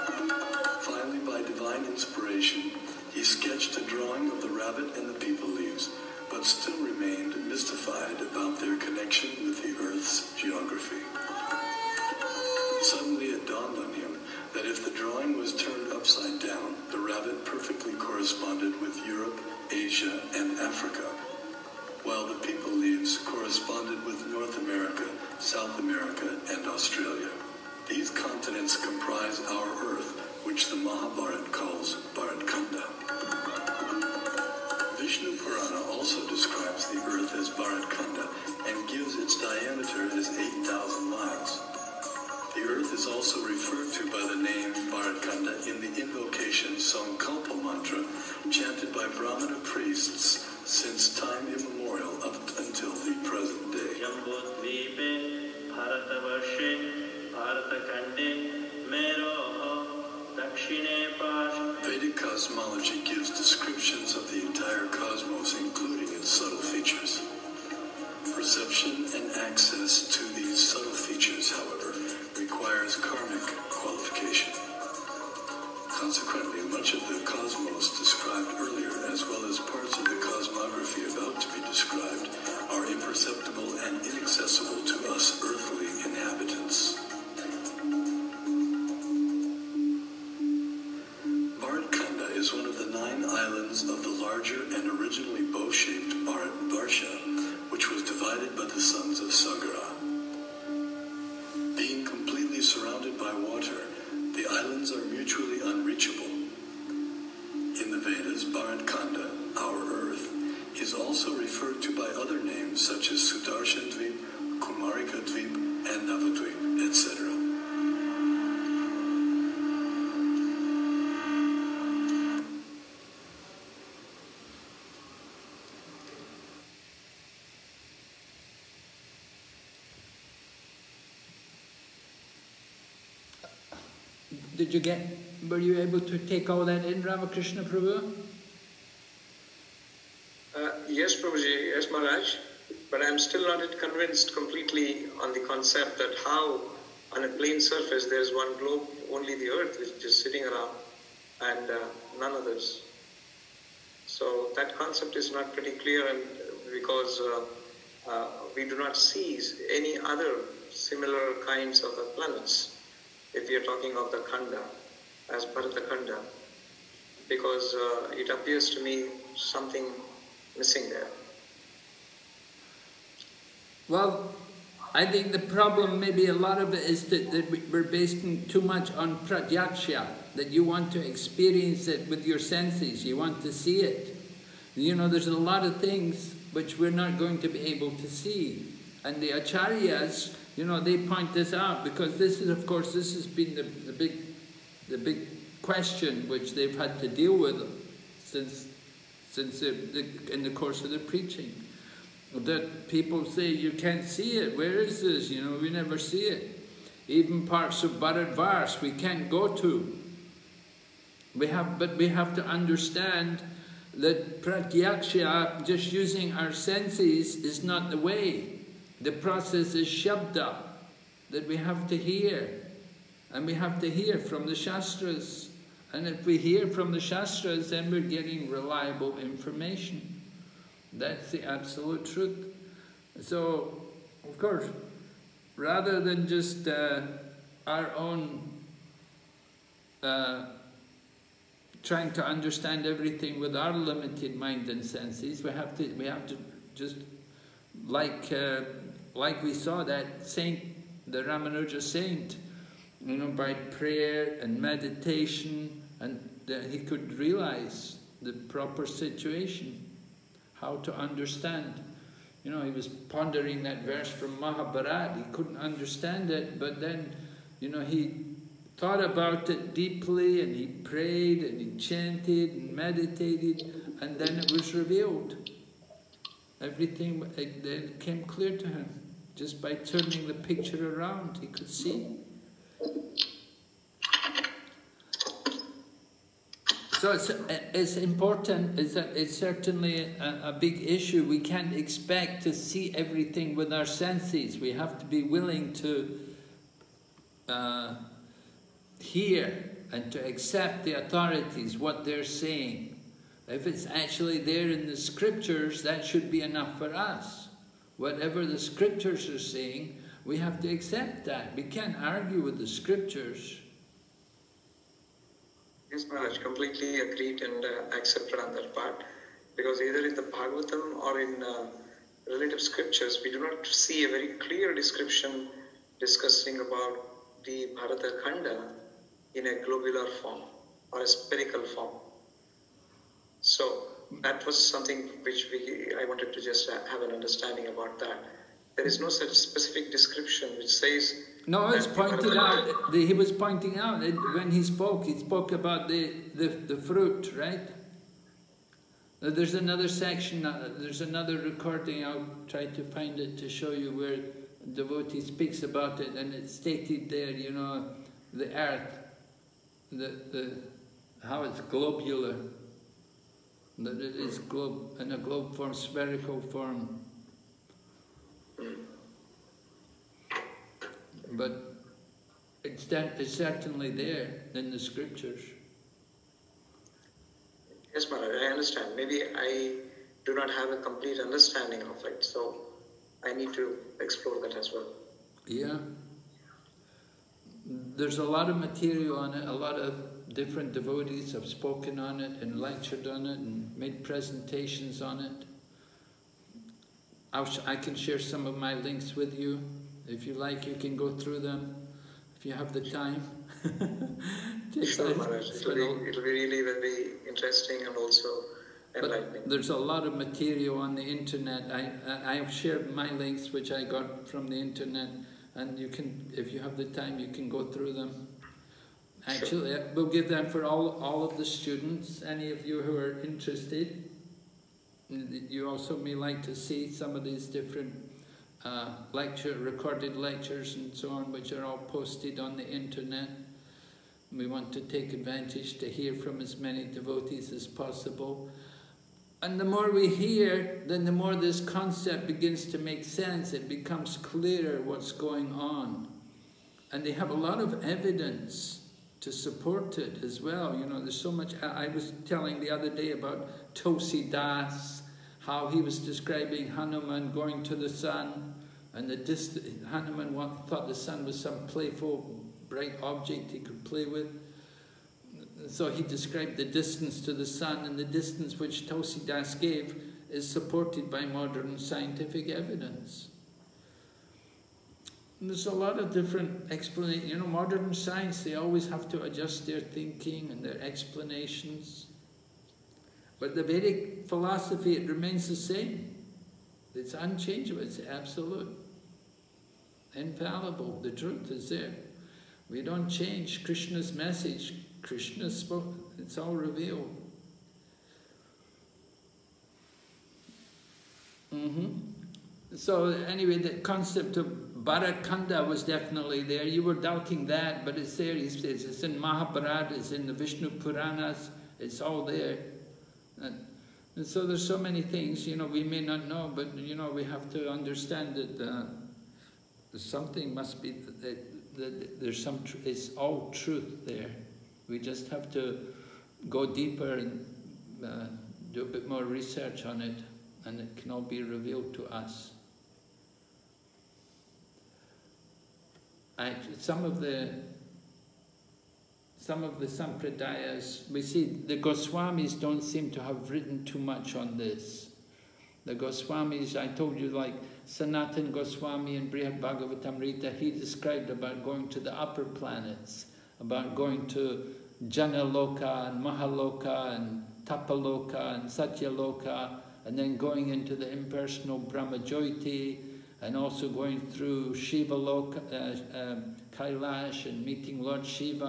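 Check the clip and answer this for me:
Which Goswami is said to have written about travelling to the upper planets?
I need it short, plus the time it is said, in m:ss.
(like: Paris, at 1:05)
Sanatan Goswami, at 9:07.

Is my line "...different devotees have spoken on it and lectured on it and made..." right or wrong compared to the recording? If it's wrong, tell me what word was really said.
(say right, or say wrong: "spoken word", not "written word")
right.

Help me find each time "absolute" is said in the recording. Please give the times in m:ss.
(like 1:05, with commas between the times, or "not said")
3:51, 8:08.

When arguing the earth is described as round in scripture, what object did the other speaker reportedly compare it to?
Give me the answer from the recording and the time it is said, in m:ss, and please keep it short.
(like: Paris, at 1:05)
the fruit, at 5:46.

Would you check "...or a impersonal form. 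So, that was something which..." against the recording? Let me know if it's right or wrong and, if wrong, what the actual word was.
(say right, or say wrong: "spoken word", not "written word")
wrong: "spherical", not "impersonal".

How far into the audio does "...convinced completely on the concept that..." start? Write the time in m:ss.
2:23.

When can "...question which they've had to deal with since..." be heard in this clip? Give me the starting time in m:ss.
3:15.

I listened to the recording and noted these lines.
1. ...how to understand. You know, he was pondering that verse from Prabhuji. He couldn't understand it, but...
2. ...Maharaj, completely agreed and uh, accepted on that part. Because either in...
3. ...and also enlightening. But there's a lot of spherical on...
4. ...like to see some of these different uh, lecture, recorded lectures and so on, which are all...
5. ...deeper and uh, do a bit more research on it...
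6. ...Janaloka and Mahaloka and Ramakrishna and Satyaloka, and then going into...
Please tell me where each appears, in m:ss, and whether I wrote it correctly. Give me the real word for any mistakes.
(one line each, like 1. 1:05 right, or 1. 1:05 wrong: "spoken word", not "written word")
1. 4:20 wrong: "Mahabharata", not "Prabhuji"
2. 5:16 right
3. 6:47 wrong: "material", not "spherical"
4. 7:06 right
5. 8:46 right
6. 9:15 wrong: "Tapaloka", not "Ramakrishna".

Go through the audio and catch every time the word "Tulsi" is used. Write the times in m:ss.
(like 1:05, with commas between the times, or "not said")
7:33, 7:48.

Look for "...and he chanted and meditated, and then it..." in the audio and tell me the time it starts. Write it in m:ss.
4:31.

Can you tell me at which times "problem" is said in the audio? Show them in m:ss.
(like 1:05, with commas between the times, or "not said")
2:55.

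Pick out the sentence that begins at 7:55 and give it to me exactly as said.
And there's a lot of different explanations.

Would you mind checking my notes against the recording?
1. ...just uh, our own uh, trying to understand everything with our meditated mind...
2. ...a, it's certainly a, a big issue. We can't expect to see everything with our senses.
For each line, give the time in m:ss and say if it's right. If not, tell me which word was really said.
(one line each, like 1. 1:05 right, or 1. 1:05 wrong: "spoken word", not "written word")
1. 3:56 wrong: "limited", not "meditated"
2. 4:48 right.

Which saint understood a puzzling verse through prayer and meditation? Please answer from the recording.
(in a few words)
Ramanuja.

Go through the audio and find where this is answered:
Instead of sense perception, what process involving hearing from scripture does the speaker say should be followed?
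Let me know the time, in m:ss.
3:39.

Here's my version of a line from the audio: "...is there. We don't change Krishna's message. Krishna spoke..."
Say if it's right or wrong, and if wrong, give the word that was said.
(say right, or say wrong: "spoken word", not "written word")
right.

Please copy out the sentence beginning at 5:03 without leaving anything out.
If it's actually there in the scriptures, that should be enough for us.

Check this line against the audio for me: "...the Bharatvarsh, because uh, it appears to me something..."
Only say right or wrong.
wrong.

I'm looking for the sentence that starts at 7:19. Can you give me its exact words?
And the more we hear, then the more this concept begins to make sense.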